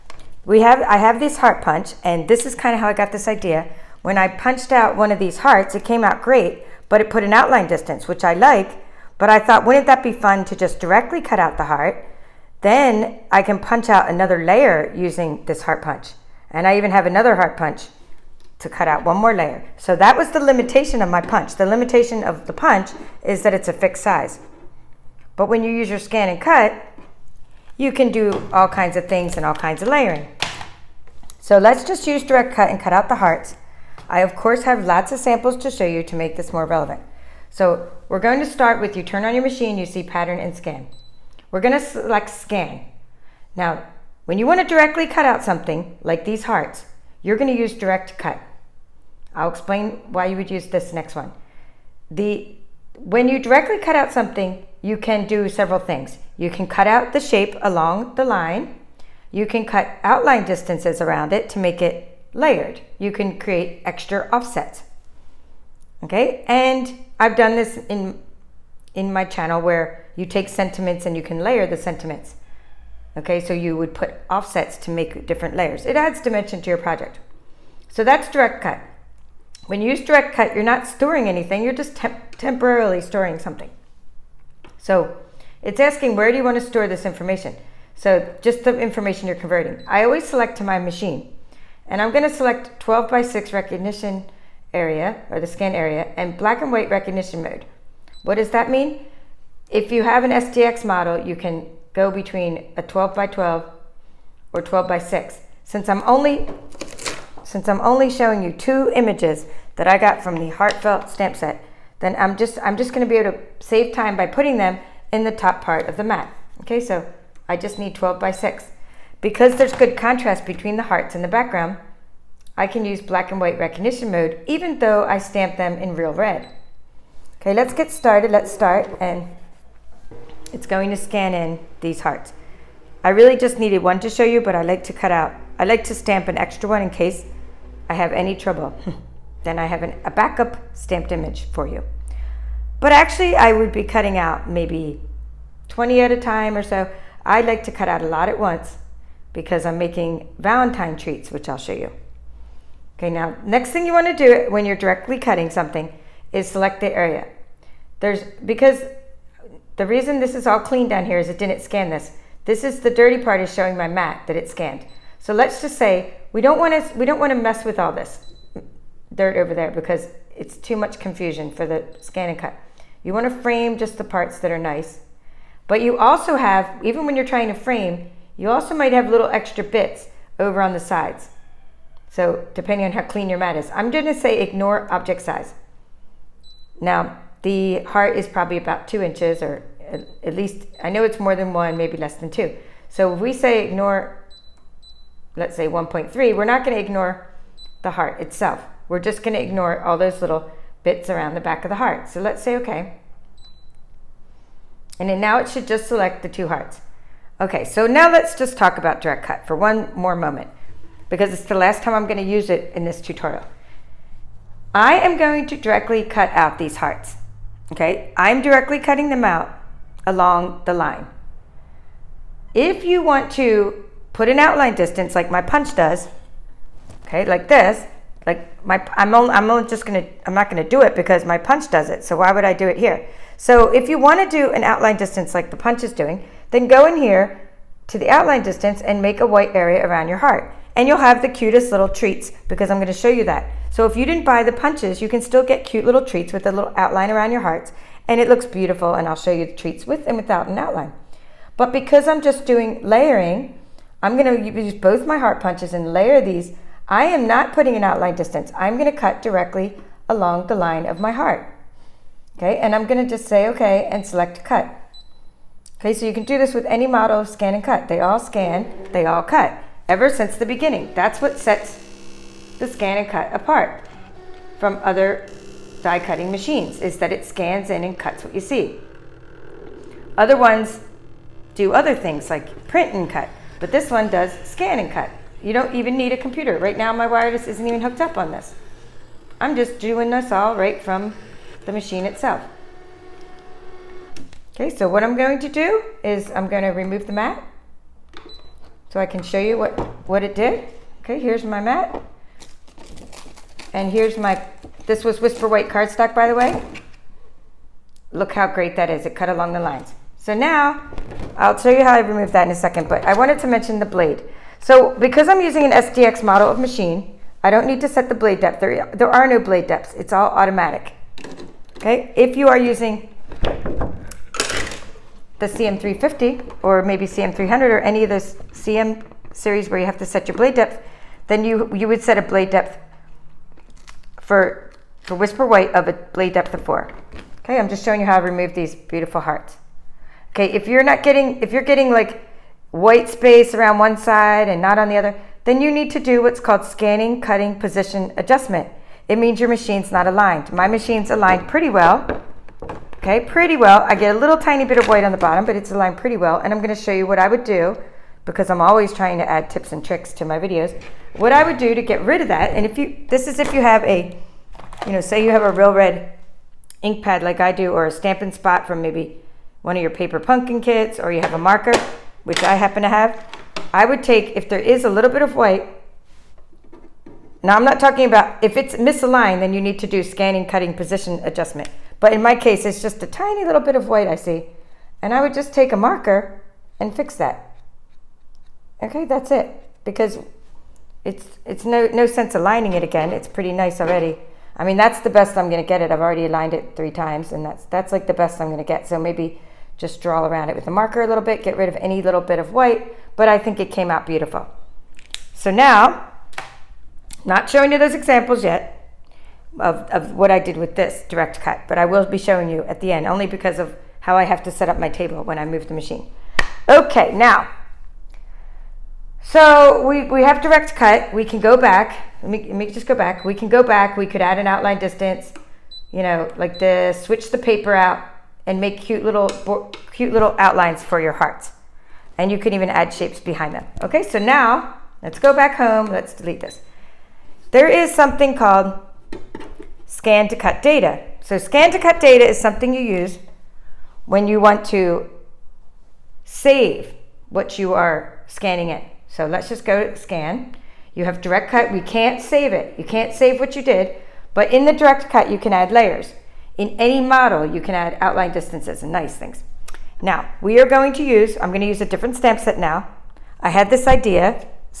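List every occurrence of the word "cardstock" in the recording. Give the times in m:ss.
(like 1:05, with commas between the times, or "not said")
5:05.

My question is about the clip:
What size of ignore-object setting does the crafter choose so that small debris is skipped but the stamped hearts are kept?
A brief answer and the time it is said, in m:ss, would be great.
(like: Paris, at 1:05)
1.3, at 3:15.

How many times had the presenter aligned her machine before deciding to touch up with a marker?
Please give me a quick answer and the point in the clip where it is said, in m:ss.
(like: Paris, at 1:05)
3, at 6:36.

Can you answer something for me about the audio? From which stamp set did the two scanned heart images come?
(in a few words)
Heartfelt.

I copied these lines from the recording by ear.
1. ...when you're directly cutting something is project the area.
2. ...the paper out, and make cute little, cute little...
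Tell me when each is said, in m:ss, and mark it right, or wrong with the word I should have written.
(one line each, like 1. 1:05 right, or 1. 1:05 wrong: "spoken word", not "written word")
1. 2:34 wrong: "select", not "project"
2. 7:07 right.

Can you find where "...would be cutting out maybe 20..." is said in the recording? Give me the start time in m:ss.
2:23.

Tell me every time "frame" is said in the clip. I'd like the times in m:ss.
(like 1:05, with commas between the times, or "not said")
2:53, 2:57.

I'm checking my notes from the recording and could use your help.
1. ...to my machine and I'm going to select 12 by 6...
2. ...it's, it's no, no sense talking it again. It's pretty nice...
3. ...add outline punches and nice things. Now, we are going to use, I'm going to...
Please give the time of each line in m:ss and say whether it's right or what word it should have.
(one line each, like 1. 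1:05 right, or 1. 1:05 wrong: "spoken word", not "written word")
1. 1:30 right
2. 6:31 wrong: "aligning", not "talking"
3. 7:37 wrong: "distances", not "punches".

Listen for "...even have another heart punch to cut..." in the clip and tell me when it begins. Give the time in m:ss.
0:16.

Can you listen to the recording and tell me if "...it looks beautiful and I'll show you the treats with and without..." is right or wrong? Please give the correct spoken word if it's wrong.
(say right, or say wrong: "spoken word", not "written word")
right.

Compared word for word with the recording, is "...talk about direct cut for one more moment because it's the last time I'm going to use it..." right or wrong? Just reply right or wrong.
right.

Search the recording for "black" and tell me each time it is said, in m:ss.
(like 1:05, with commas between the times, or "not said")
1:36, 2:03.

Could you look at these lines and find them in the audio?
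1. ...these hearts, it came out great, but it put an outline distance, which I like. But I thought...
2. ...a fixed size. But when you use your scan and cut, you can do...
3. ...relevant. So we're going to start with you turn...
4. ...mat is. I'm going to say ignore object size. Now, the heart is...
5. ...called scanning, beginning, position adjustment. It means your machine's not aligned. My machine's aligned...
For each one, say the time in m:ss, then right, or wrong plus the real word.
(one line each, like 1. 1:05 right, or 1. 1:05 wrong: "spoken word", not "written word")
1. 0:05 right
2. 0:23 right
3. 0:36 right
4. 3:03 right
5. 5:46 wrong: "cutting", not "beginning".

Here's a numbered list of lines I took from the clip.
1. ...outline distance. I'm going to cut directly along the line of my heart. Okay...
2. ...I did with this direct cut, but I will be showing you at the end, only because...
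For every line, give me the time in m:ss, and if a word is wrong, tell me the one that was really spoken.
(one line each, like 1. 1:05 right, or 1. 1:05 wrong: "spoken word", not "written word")
1. 4:17 right
2. 6:50 right.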